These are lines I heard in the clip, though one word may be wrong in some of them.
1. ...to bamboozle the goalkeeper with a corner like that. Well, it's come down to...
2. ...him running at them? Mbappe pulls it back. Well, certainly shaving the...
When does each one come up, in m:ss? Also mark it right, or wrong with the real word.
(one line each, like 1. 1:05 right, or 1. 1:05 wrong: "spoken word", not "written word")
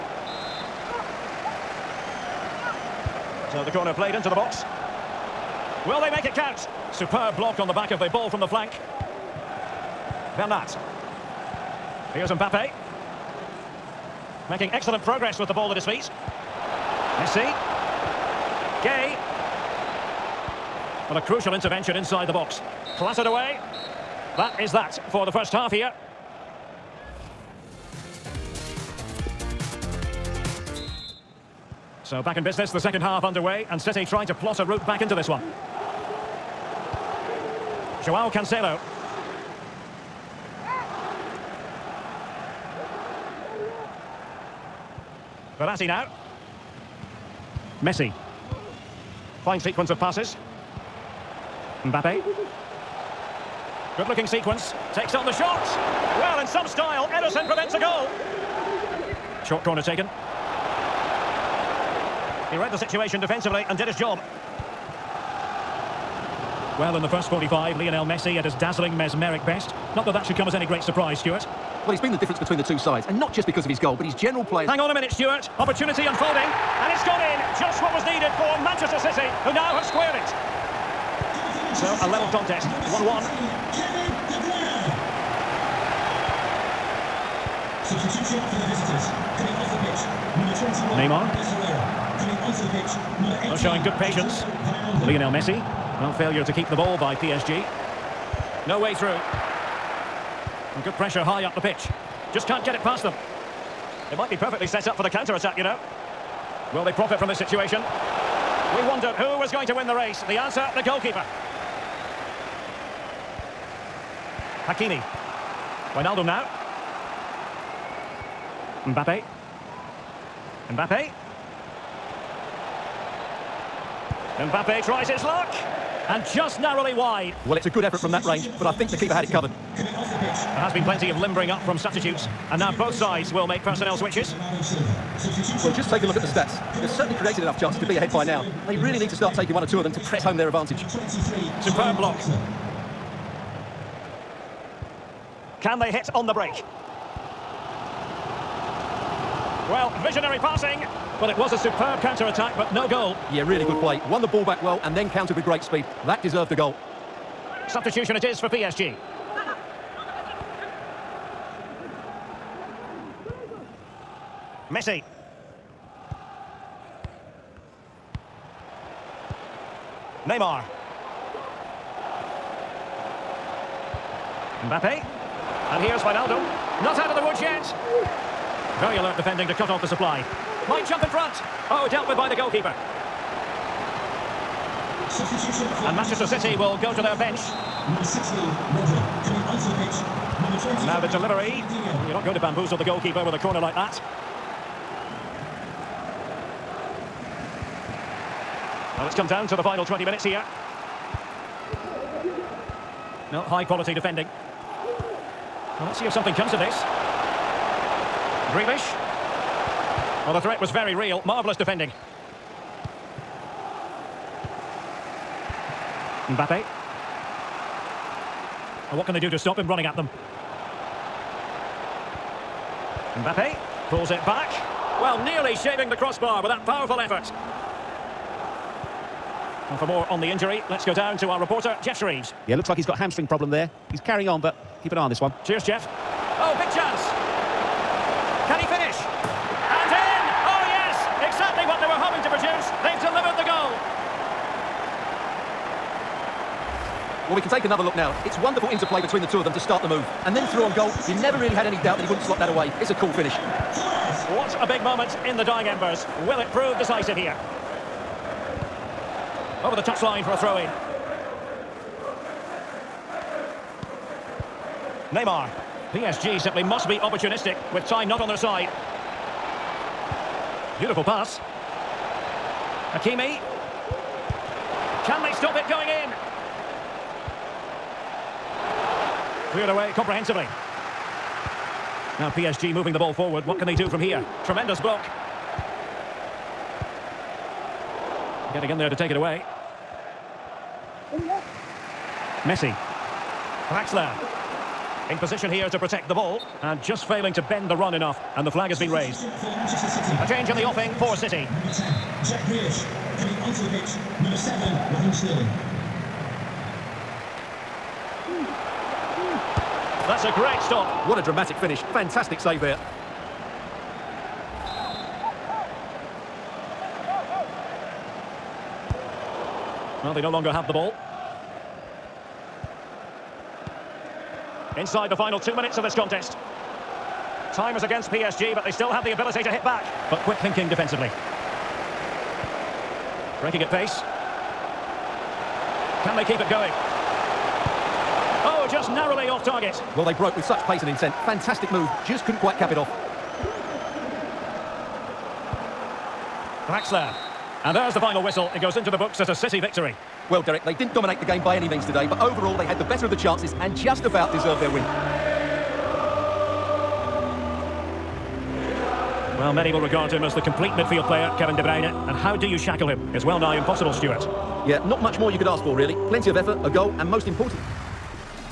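1. 3:12 right
2. 3:39 wrong: "nearly", not "certainly".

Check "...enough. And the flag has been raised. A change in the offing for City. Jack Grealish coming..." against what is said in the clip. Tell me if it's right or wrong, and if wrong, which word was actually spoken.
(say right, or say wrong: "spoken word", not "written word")
right.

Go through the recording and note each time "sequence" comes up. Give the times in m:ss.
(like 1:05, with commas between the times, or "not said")
0:49, 0:54.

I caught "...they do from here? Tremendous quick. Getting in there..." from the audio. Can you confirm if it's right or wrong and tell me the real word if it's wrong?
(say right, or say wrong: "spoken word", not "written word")
wrong: "block", not "quick".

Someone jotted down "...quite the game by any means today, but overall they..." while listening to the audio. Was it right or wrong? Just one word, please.
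wrong.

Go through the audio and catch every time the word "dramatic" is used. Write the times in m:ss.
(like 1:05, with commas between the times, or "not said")
5:11.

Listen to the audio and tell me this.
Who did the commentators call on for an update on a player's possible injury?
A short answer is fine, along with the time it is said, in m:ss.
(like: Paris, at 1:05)
Geoff Shreeves, at 3:51.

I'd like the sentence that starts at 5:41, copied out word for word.
Fantastic move, just couldn't quite cap it off.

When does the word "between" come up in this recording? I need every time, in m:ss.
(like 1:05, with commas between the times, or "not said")
1:12, 4:09.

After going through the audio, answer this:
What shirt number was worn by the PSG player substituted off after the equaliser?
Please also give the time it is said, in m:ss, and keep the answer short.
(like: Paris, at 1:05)
21, at 1:30.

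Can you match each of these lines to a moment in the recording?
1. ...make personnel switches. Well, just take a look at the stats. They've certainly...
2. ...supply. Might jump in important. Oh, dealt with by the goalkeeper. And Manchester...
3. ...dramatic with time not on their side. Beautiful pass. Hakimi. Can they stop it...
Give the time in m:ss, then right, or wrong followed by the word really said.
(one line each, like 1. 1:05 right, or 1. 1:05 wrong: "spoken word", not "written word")
1. 2:13 right
2. 2:59 wrong: "front", not "important"
3. 4:26 wrong: "opportunistic", not "dramatic".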